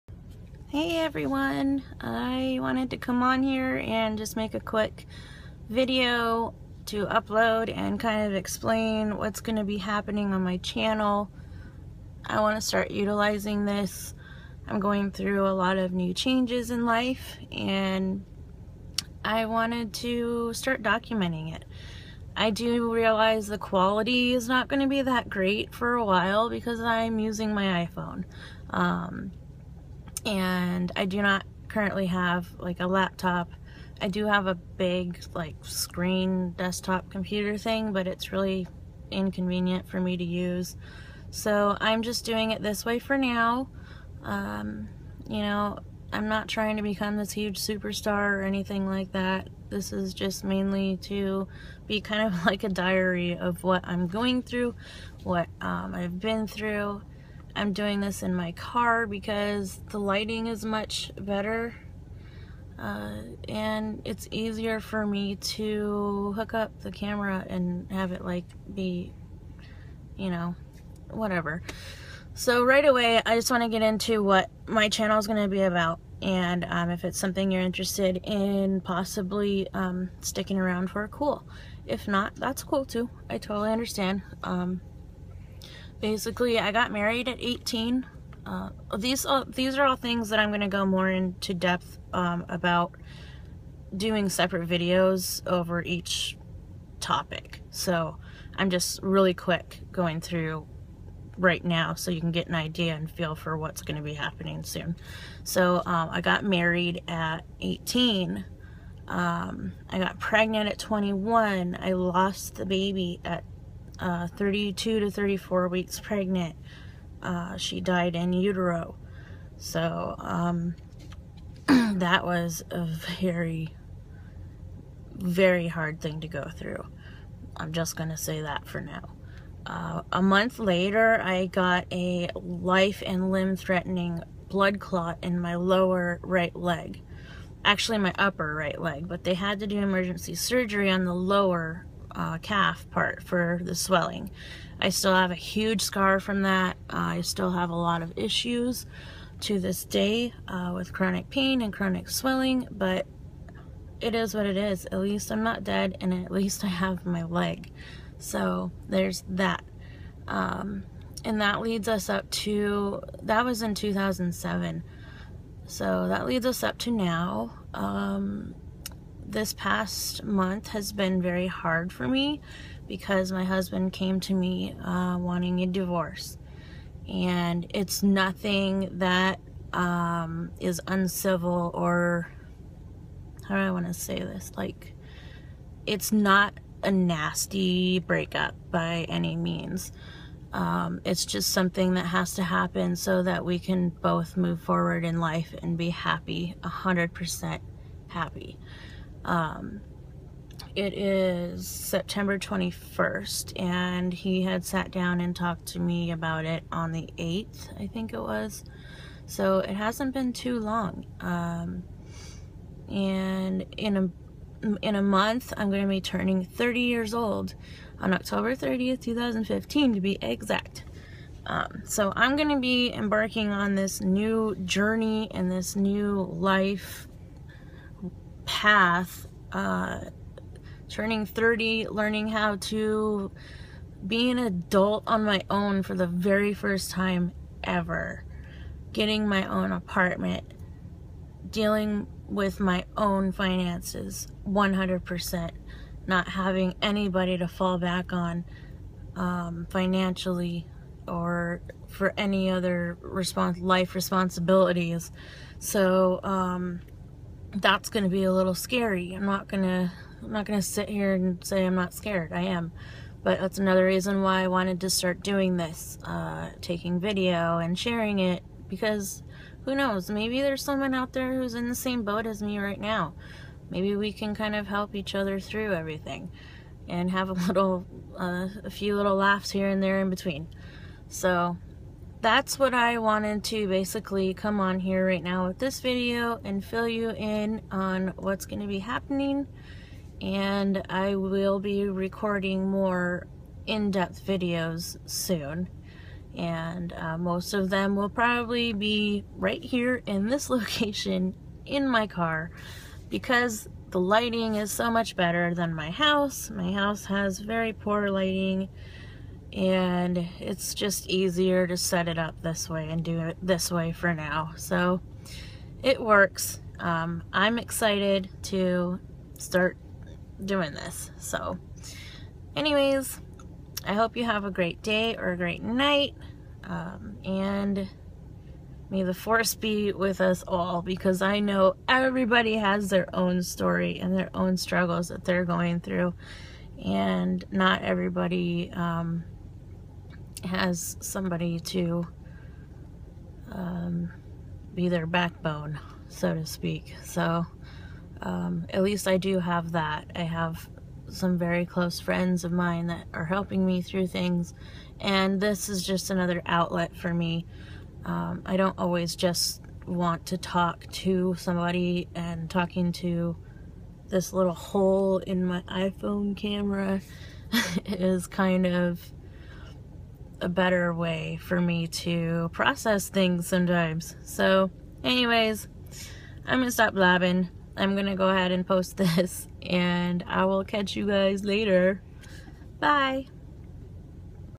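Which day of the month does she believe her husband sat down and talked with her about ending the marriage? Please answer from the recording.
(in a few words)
the 8th.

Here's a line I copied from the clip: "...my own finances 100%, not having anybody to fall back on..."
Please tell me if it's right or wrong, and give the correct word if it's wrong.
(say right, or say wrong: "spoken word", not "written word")
right.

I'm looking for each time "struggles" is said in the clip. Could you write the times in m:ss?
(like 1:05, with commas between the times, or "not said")
5:34.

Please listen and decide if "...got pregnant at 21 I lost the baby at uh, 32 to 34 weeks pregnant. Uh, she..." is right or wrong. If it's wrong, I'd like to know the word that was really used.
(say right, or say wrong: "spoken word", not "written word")
right.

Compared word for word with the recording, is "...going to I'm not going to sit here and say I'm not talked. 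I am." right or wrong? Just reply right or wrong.
wrong.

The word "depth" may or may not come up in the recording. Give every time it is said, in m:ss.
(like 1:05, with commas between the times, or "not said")
1:31, 4:53.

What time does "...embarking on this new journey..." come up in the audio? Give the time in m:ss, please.
3:42.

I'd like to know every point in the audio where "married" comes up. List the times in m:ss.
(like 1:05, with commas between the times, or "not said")
1:26, 1:46.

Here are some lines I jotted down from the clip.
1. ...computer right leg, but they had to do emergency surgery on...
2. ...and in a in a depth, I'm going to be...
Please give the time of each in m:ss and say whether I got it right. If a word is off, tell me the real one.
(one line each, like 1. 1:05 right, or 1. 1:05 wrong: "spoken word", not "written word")
1. 2:18 wrong: "upper", not "computer"
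2. 3:32 wrong: "month", not "depth".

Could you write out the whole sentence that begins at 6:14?
So, anyways, I'm gonna stop blabbing.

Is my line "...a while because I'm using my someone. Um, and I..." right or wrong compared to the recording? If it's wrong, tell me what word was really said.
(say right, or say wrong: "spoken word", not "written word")
wrong: "iPhone", not "someone".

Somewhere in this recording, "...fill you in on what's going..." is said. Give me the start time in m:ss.
4:46.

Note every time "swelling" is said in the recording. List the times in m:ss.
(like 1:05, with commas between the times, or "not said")
2:23, 2:32.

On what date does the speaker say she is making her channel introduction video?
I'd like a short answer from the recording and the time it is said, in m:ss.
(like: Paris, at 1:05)
September 21st, at 3:21.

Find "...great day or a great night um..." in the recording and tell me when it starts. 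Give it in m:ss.
5:24.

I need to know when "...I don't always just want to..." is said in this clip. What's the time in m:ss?
5:58.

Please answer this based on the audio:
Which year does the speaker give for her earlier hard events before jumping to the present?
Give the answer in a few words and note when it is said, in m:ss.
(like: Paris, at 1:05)
2007, at 2:43.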